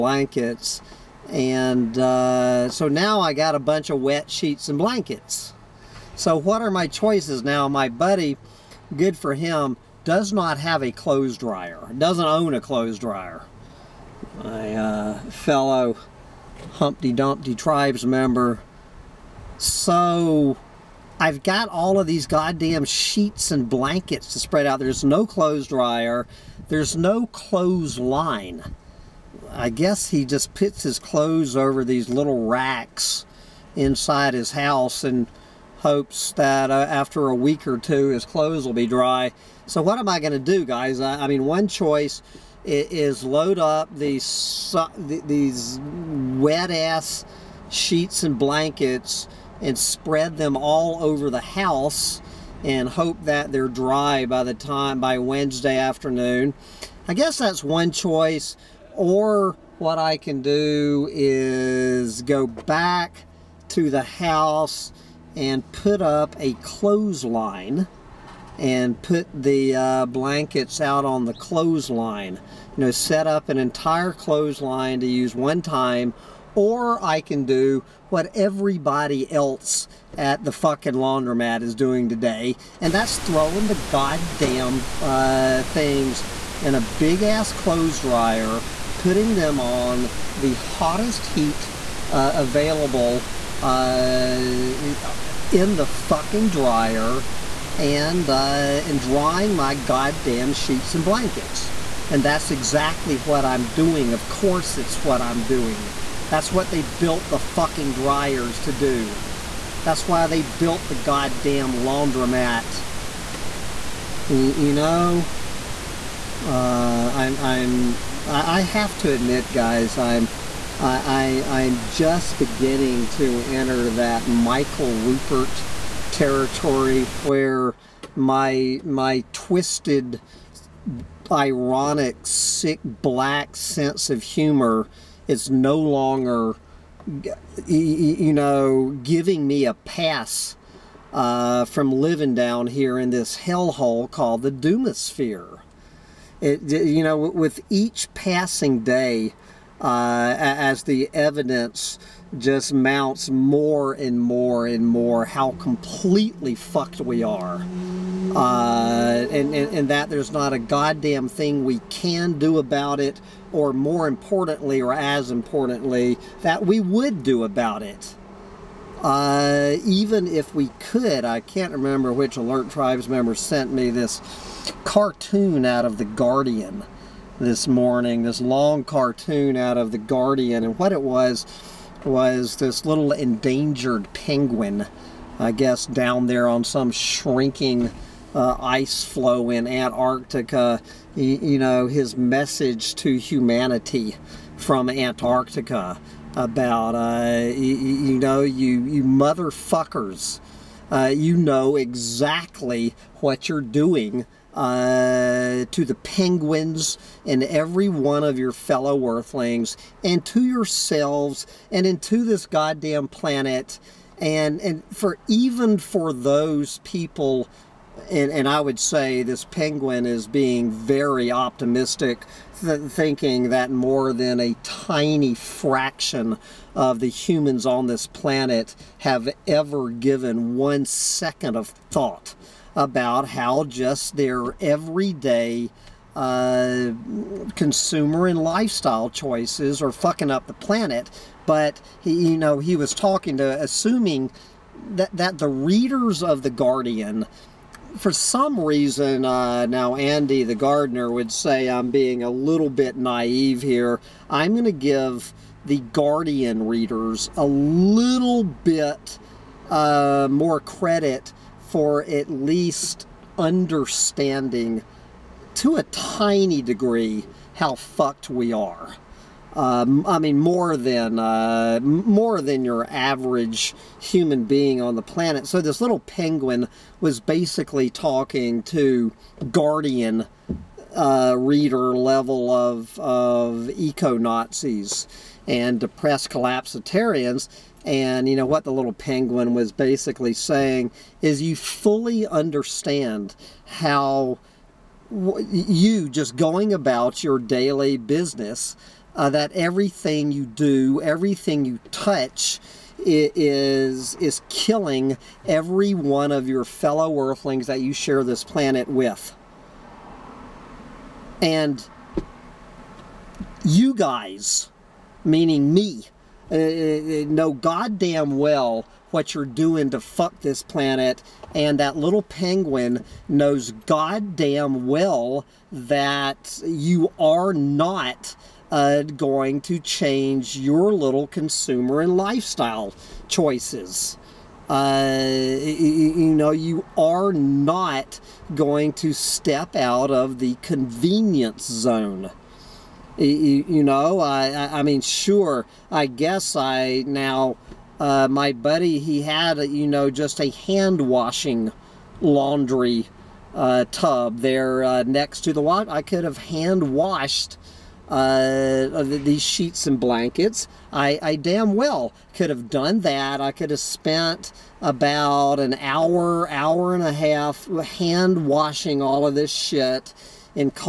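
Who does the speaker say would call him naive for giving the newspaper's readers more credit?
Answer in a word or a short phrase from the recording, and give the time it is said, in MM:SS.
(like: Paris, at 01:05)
Andy the gardener, at 04:09.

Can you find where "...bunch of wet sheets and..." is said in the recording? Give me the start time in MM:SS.
00:03.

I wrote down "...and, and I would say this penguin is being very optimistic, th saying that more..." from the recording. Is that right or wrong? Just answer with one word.
wrong.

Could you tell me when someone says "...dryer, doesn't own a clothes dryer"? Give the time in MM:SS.
00:11.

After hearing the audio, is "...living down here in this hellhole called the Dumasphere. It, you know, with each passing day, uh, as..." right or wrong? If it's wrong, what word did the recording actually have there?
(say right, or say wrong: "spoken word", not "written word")
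right.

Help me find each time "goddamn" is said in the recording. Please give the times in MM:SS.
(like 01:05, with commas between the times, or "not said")
00:22, 01:23, 01:39, 01:50, 02:40, 03:32, 05:17, 05:23.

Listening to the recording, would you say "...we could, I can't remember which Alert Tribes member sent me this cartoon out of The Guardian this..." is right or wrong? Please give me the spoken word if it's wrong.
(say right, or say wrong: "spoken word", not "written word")
right.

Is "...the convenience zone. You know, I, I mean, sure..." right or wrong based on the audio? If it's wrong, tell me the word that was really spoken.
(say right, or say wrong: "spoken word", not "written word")
right.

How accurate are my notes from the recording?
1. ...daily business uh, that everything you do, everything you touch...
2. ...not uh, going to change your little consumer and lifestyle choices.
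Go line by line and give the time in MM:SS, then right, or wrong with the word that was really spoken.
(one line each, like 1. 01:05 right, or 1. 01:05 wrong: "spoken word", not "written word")
1. 04:57 right
2. 05:27 right.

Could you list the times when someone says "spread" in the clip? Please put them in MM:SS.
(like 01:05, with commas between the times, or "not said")
00:24, 00:49.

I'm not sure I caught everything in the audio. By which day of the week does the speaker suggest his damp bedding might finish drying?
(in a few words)
Wednesday.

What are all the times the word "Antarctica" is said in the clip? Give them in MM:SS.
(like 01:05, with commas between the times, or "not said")
03:09, 03:14.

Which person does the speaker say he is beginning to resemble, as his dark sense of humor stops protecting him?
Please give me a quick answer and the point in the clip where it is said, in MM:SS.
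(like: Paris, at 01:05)
Michael Ruppert, at 02:04.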